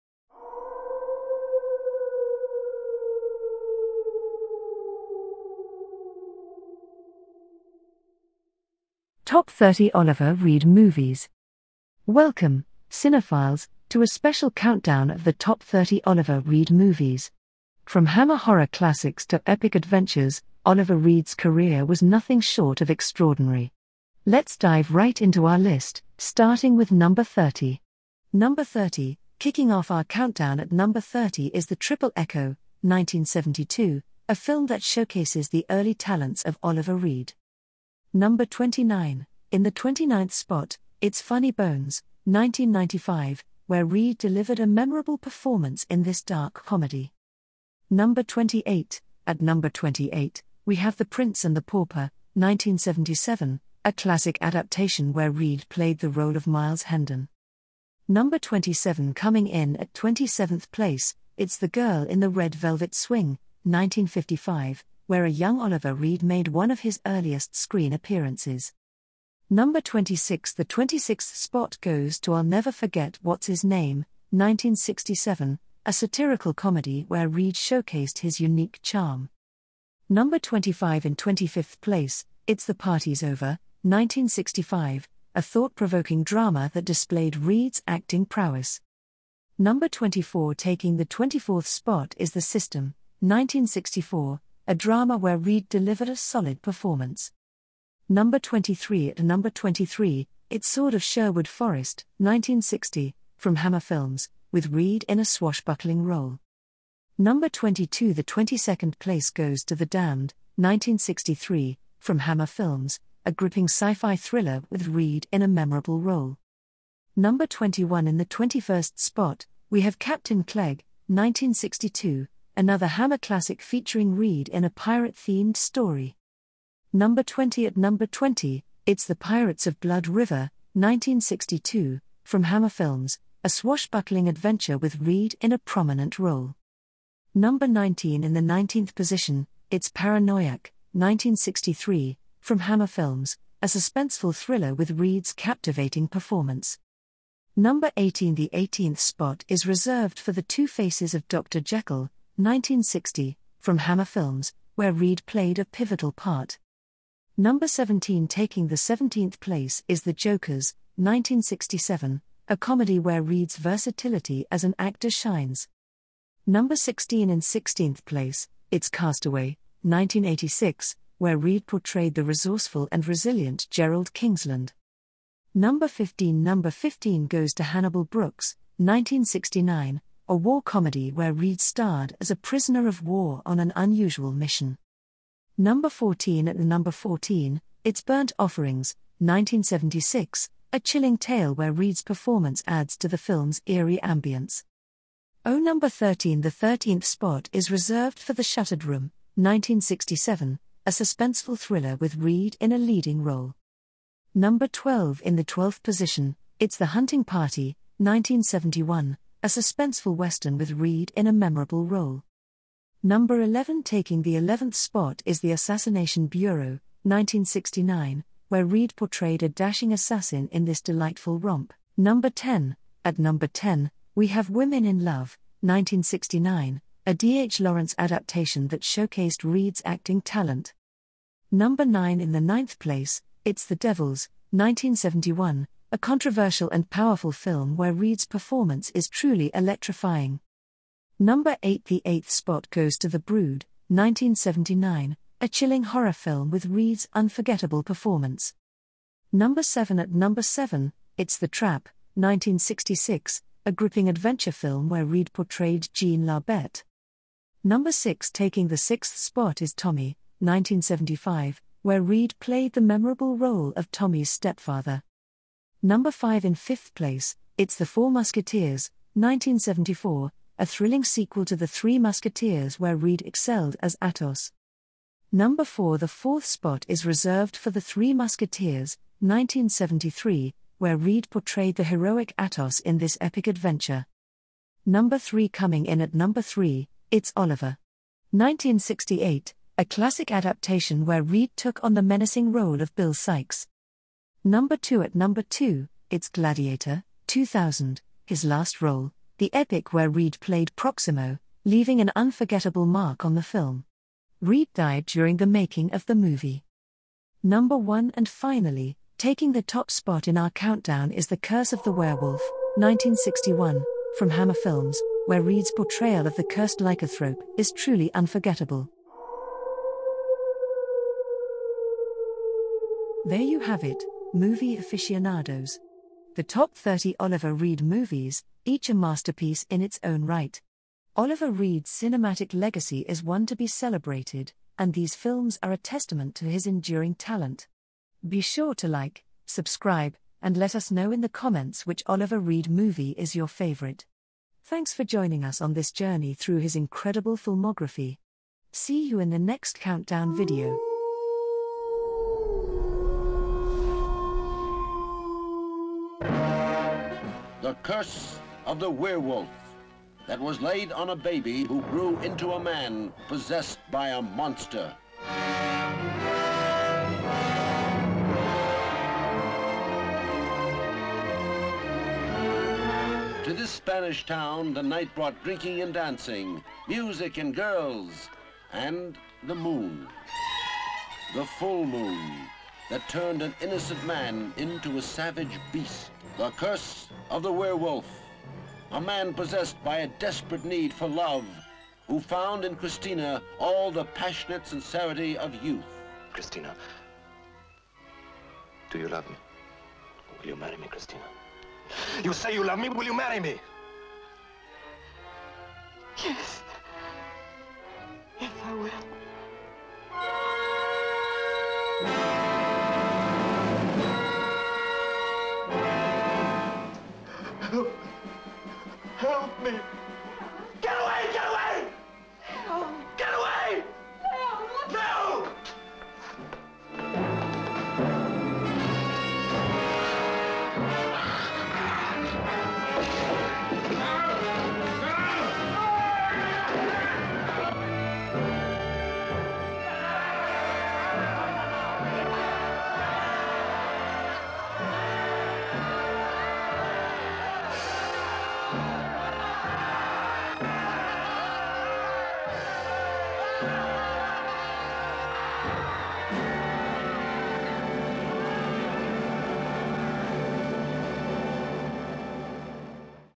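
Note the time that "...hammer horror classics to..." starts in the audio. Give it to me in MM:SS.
00:18.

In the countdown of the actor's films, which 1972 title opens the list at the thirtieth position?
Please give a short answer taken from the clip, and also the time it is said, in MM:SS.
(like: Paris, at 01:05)
The Triple Echo, at 00:31.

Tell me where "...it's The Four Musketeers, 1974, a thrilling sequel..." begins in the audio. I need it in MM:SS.
04:27.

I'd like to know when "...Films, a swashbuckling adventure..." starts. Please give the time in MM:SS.
02:12.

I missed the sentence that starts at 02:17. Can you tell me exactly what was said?
Number 19 in the 19th position, it's Paranoiac, 1963, from Hammer Films, a suspenseful thriller with Reed's captivating performance.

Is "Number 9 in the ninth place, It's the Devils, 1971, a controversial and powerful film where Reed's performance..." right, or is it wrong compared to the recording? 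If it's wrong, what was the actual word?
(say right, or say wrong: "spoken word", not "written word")
right.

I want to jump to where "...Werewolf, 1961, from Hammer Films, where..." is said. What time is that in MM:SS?
05:11.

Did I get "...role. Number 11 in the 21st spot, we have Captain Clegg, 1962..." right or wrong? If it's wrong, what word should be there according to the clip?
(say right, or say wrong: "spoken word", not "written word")
wrong: "21", not "11".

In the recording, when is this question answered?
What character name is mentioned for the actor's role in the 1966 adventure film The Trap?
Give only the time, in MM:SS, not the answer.
04:15.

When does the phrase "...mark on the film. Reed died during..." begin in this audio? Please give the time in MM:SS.
05:02.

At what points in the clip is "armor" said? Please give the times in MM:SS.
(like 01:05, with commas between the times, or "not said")
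not said.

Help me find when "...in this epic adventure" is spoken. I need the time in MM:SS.
04:42.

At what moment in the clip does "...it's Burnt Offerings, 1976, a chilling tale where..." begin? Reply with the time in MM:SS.
03:07.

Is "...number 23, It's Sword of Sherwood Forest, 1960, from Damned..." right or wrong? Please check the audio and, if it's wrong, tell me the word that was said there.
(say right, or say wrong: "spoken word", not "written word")
wrong: "Hammer", not "Damned".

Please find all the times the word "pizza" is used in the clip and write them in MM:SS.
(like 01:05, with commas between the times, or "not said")
not said.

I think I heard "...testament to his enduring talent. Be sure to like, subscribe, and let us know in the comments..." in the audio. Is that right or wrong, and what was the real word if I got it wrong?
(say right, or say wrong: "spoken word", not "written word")
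right.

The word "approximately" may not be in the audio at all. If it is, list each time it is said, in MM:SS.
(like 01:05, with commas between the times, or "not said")
not said.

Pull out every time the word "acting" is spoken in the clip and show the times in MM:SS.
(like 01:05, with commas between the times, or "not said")
01:27, 03:49.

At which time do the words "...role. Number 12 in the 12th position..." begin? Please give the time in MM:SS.
03:23.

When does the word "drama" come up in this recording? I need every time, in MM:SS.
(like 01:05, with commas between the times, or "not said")
01:26, 01:34.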